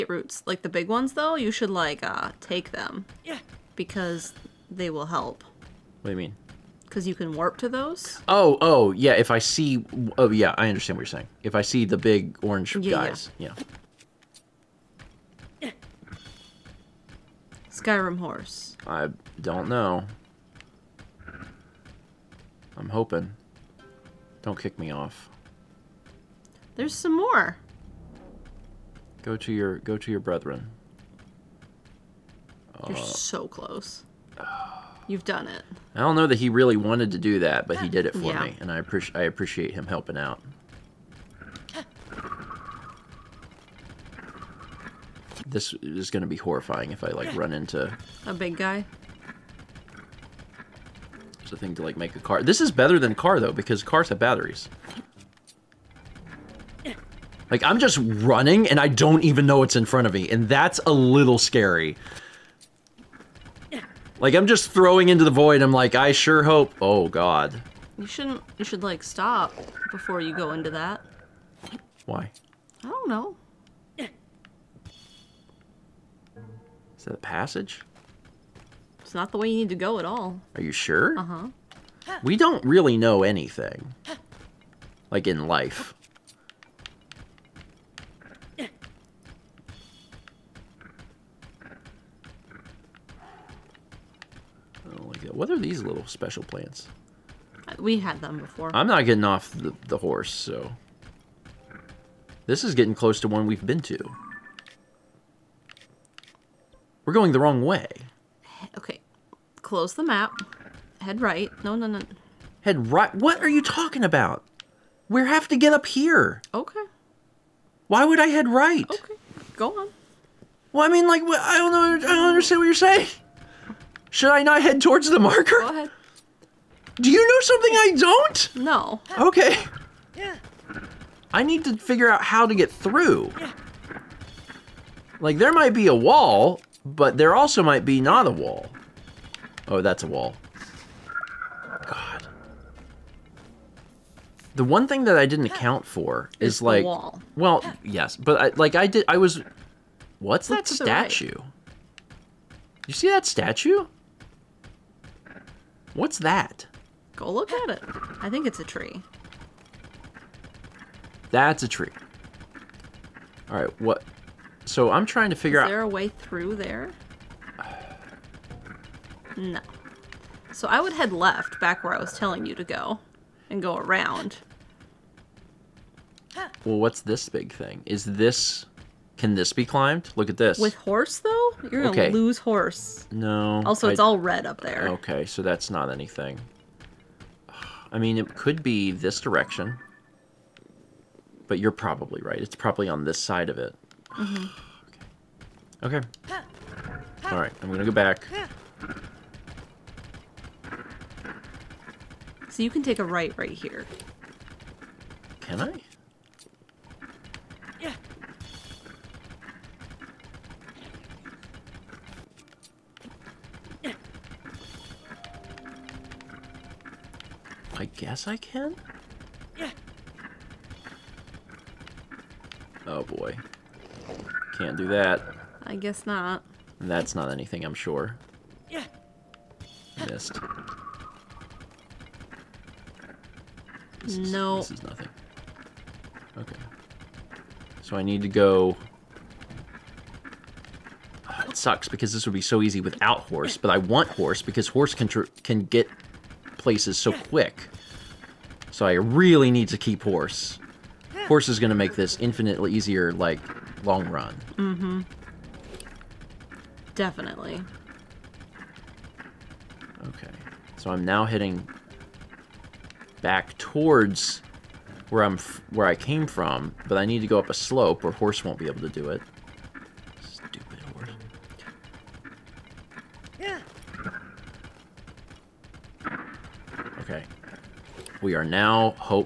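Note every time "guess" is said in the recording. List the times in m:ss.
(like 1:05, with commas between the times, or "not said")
3:37, 3:45.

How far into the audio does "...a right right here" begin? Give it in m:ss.
3:23.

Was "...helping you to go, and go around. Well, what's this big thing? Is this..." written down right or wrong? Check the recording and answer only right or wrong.
wrong.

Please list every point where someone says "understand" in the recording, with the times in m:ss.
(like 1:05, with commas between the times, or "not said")
0:10, 2:02.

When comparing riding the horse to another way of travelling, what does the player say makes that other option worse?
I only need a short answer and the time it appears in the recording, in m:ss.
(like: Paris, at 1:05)
batteries, at 0:54.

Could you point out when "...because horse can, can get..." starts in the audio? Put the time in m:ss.
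4:04.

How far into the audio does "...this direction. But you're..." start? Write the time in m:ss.
3:08.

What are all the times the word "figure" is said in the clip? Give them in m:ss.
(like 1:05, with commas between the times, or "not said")
2:11, 2:45.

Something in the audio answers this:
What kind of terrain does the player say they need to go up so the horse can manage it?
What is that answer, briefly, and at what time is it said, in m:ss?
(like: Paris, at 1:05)
a slope, at 4:27.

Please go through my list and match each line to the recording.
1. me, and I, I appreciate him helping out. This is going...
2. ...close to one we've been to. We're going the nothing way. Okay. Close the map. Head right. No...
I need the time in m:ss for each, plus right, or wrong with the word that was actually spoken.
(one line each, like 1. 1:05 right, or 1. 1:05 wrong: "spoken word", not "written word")
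1. 0:38 right
2. 1:42 wrong: "wrong", not "nothing".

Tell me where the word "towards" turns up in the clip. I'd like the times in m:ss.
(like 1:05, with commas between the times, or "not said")
2:04, 4:23.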